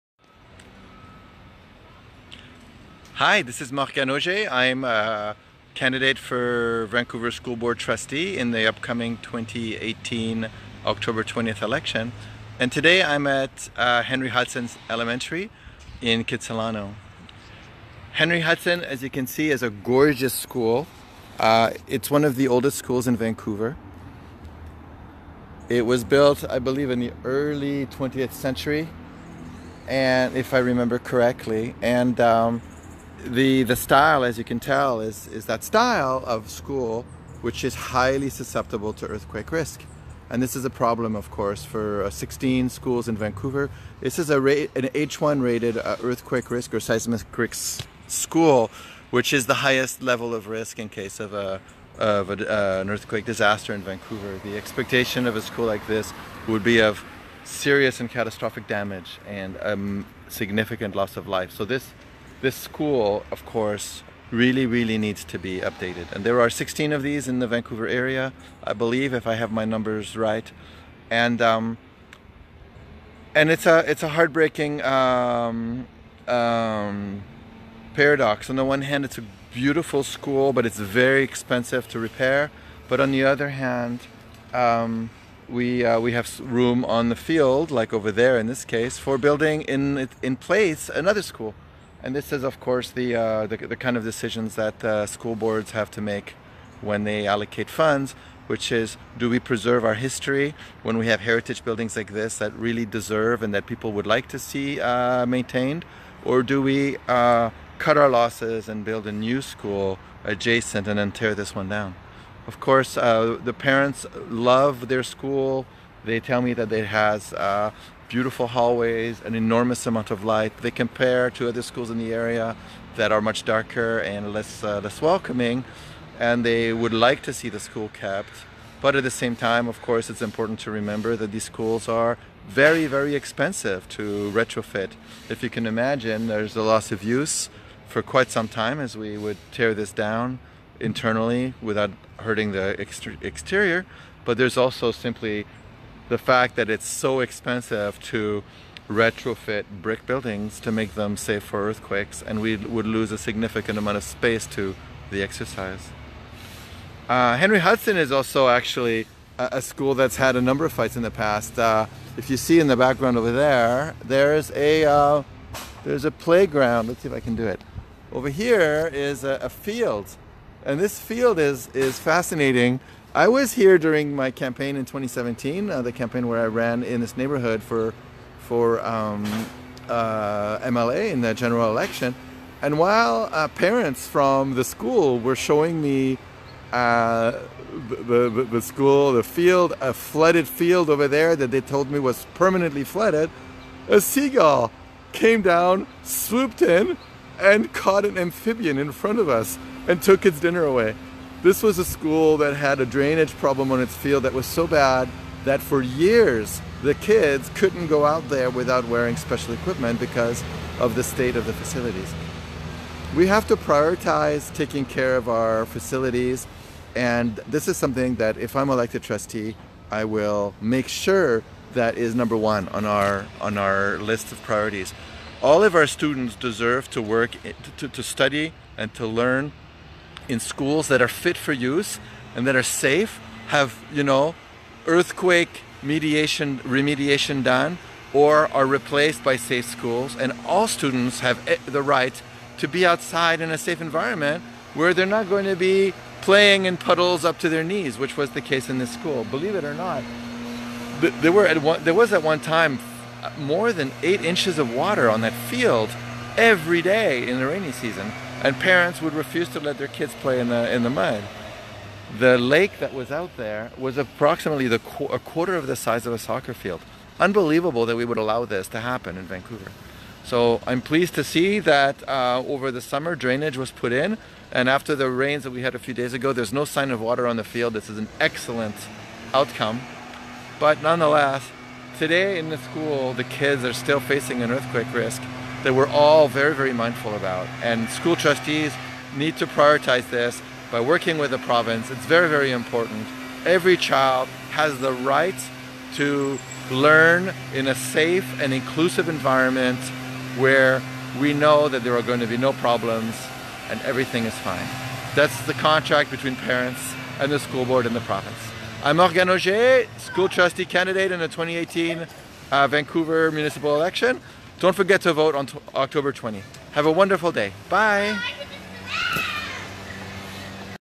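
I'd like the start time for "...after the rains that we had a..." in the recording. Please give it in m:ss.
4:34.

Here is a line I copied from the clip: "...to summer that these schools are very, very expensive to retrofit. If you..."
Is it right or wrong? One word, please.
wrong.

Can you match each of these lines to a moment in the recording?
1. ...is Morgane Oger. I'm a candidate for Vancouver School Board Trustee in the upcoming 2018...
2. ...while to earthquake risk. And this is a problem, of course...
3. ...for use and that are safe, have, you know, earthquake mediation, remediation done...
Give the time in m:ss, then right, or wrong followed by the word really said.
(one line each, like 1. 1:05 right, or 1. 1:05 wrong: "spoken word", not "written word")
1. 0:03 right
2. 0:38 wrong: "susceptible", not "while"
3. 3:51 right.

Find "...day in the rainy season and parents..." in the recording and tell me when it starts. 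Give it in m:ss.
4:16.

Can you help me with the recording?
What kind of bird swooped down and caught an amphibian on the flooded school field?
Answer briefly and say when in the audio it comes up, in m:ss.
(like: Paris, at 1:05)
Seagull, at 3:14.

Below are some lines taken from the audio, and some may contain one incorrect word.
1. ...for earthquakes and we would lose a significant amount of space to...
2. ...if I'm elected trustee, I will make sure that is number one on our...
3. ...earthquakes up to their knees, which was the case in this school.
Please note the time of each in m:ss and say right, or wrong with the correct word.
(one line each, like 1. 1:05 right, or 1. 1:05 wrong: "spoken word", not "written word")
1. 2:31 right
2. 3:38 right
3. 4:06 wrong: "puddles", not "earthquakes".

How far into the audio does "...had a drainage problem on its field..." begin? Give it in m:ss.
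3:22.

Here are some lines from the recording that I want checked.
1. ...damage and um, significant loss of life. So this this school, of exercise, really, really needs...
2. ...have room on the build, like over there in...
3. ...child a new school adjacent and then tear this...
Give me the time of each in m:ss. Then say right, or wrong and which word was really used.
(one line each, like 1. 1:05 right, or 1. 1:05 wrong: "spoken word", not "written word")
1. 0:58 wrong: "course", not "exercise"
2. 1:26 wrong: "field", not "build"
3. 1:48 wrong: "build", not "child".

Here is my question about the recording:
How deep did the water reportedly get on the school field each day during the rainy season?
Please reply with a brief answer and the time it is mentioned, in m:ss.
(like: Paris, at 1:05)
More than 8 inches, at 4:13.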